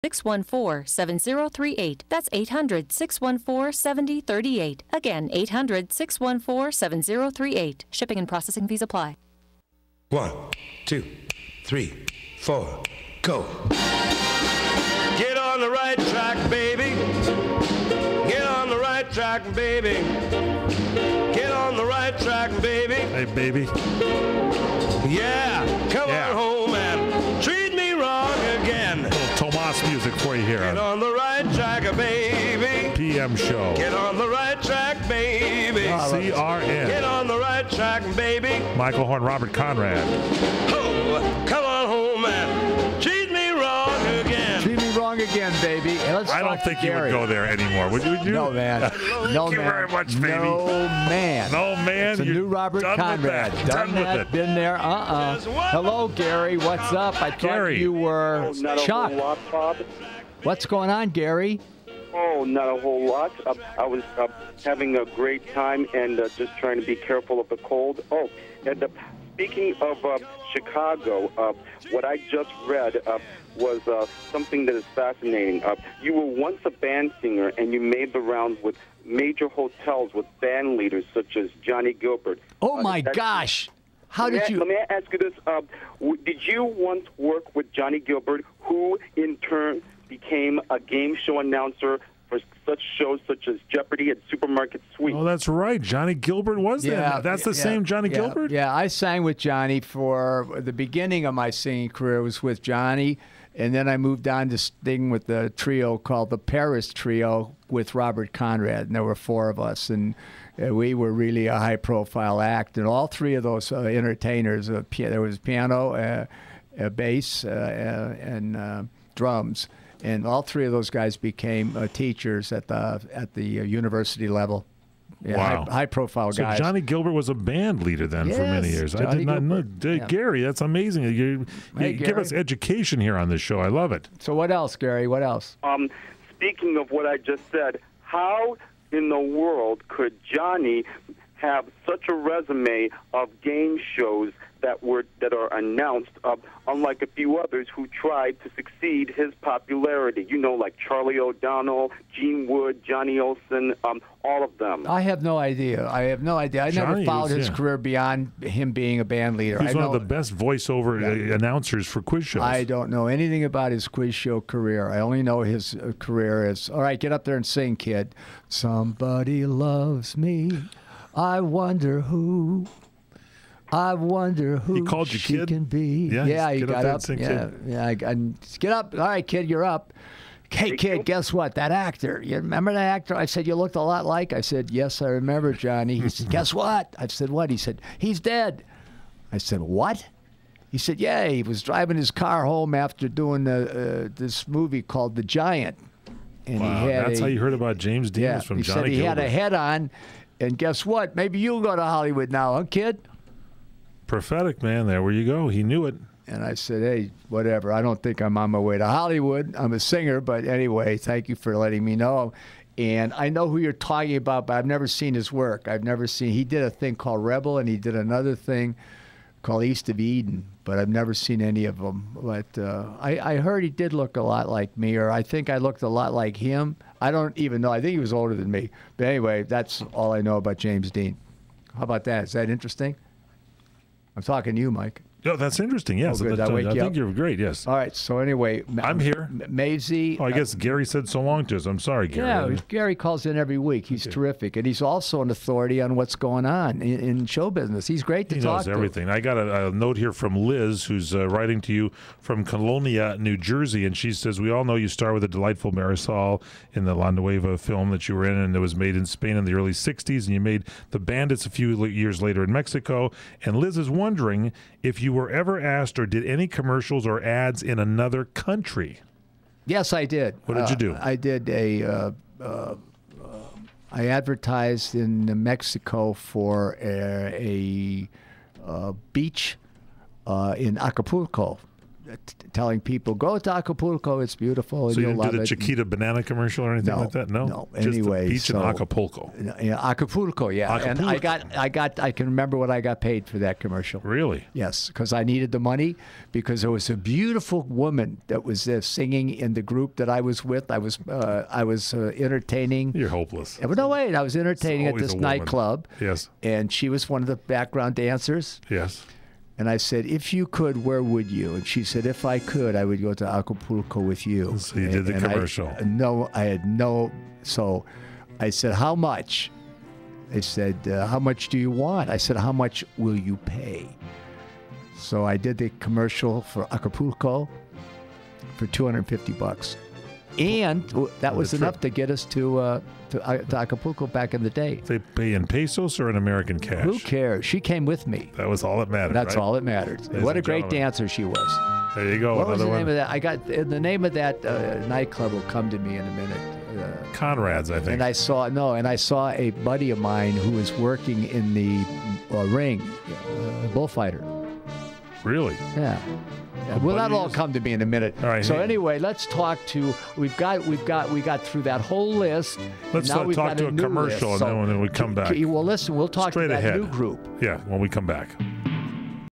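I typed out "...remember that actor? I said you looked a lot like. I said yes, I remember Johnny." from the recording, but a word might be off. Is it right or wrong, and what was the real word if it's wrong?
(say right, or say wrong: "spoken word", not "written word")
right.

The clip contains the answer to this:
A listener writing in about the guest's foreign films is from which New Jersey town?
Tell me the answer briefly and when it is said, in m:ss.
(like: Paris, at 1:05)
Colonia, at 4:12.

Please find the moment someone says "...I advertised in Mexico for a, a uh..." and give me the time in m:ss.
4:33.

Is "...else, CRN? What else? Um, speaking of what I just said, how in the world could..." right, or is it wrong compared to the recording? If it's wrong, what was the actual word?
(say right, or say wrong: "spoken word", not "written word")
wrong: "Gary", not "CRN".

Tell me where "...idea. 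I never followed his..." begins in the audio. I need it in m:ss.
2:36.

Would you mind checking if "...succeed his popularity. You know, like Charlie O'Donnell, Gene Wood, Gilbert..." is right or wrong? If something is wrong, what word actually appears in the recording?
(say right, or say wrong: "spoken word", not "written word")
wrong: "Johnny", not "Gilbert".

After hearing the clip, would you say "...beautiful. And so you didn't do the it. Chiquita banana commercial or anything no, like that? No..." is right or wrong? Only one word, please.
right.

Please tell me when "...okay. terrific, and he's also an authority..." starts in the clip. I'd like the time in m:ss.
4:04.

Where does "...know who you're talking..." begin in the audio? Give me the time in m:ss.
3:33.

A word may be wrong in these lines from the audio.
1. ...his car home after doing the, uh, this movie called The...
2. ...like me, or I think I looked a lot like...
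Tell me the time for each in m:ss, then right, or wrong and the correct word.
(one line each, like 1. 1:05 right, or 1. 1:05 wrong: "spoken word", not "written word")
1. 3:11 right
2. 3:44 right.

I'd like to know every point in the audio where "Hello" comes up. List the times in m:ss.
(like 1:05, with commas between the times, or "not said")
0:55.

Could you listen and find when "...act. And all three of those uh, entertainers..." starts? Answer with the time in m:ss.
1:52.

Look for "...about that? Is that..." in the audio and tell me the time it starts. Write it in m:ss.
3:51.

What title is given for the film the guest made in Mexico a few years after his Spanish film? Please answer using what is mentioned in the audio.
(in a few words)
The Bandits.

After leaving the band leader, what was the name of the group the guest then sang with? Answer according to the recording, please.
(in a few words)
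Paris Trio.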